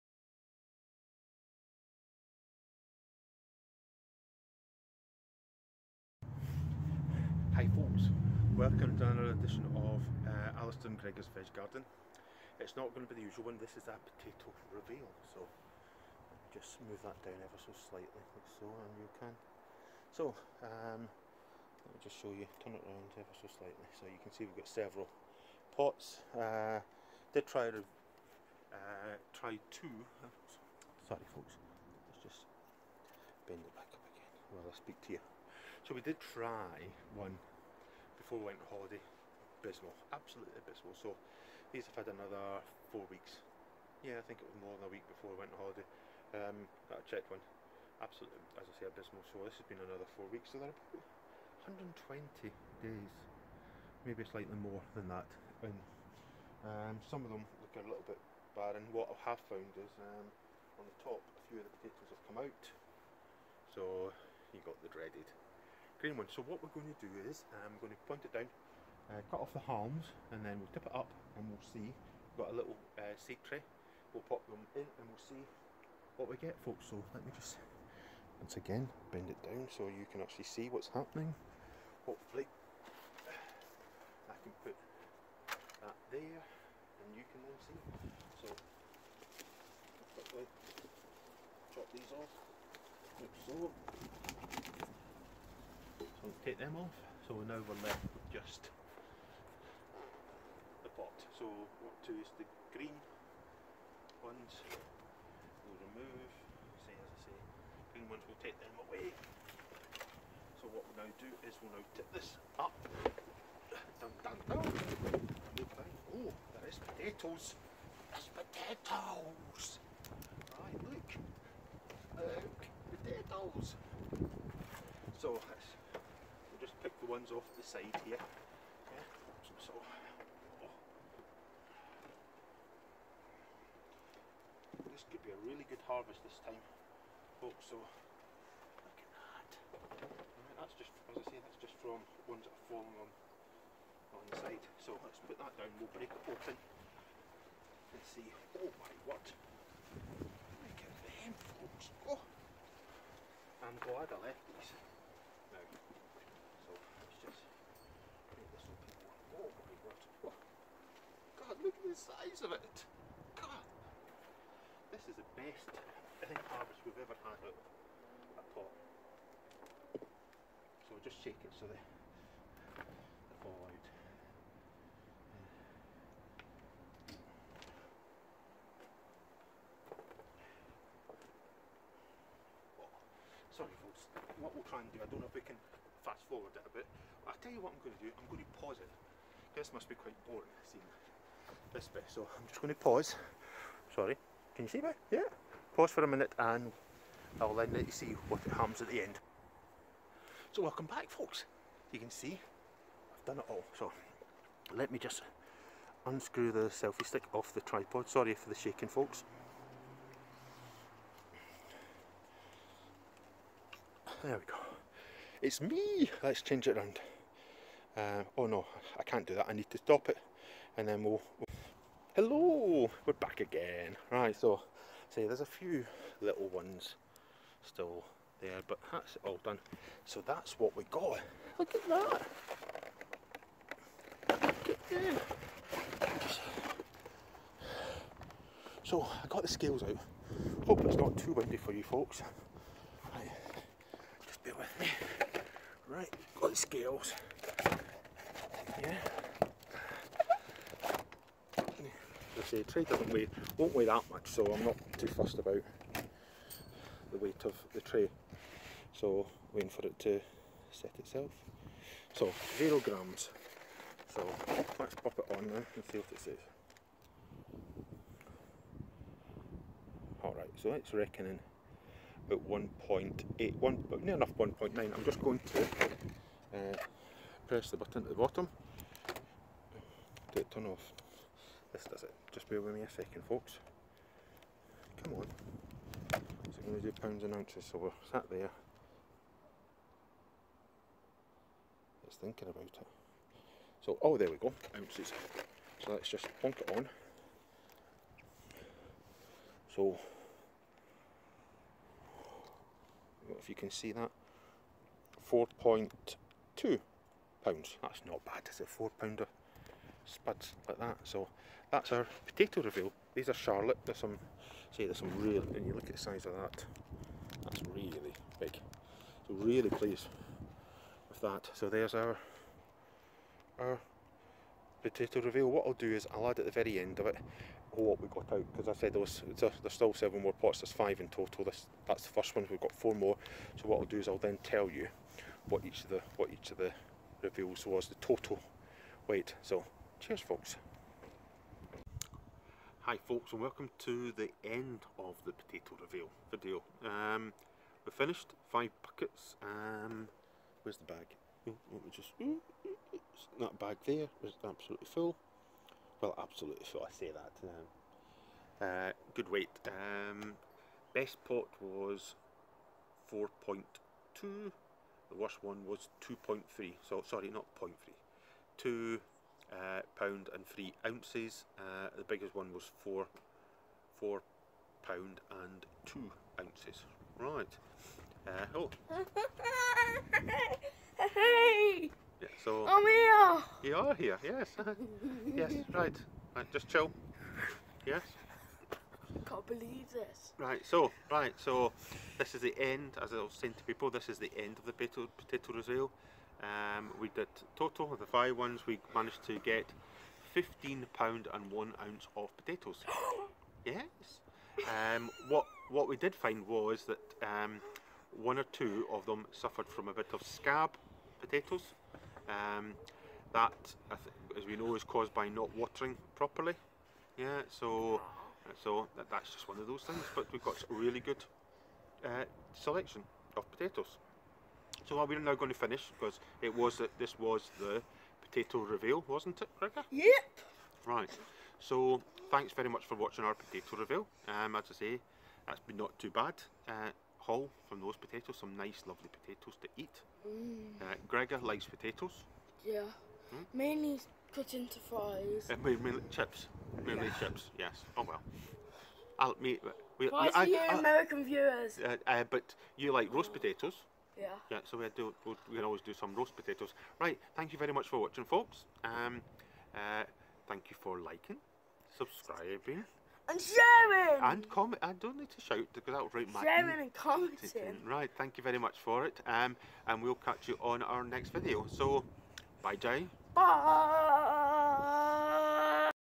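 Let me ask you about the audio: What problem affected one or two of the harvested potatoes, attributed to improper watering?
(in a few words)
scab.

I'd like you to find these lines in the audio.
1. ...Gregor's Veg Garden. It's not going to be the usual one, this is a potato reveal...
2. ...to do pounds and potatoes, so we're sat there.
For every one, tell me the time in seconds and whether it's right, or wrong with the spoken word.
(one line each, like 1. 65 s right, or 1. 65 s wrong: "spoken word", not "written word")
1. 10 s right
2. 286 s wrong: "ounces", not "potatoes".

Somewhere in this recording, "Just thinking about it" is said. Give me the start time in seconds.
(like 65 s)
292 s.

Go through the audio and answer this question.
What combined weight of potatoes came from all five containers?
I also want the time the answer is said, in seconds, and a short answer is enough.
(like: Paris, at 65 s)
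15 pounds 1 ounce, at 400 s.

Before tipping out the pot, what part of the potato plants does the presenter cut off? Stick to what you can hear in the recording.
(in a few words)
the haulms.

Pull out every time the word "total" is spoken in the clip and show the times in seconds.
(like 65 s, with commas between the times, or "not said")
331 s, 338 s, 397 s.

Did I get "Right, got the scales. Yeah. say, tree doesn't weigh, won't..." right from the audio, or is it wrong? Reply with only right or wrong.
right.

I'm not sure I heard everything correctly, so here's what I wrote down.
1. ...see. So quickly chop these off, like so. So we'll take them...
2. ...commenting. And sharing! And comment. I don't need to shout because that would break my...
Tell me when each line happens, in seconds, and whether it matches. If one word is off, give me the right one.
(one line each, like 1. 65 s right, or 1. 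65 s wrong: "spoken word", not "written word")
1. 87 s right
2. 461 s wrong: "subscribing", not "commenting".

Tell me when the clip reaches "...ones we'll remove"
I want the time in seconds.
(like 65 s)
104 s.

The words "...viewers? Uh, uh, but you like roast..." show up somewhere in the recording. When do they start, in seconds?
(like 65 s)
451 s.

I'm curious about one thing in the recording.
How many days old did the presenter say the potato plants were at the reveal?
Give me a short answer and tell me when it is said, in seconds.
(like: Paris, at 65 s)
120 days, at 52 s.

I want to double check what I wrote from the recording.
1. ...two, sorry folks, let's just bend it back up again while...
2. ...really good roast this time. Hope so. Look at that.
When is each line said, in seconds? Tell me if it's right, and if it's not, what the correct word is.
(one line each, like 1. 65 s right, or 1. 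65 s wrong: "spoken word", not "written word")
1. 29 s right
2. 135 s wrong: "harvest", not "roast".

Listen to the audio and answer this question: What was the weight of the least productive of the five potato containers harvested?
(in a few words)
2 pounds 3 ounces.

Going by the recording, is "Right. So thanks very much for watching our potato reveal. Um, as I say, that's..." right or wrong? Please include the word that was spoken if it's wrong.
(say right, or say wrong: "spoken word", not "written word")
right.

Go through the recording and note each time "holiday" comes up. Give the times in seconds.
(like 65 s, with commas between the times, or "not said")
38 s, 45 s.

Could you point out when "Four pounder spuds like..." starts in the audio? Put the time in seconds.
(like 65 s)
308 s.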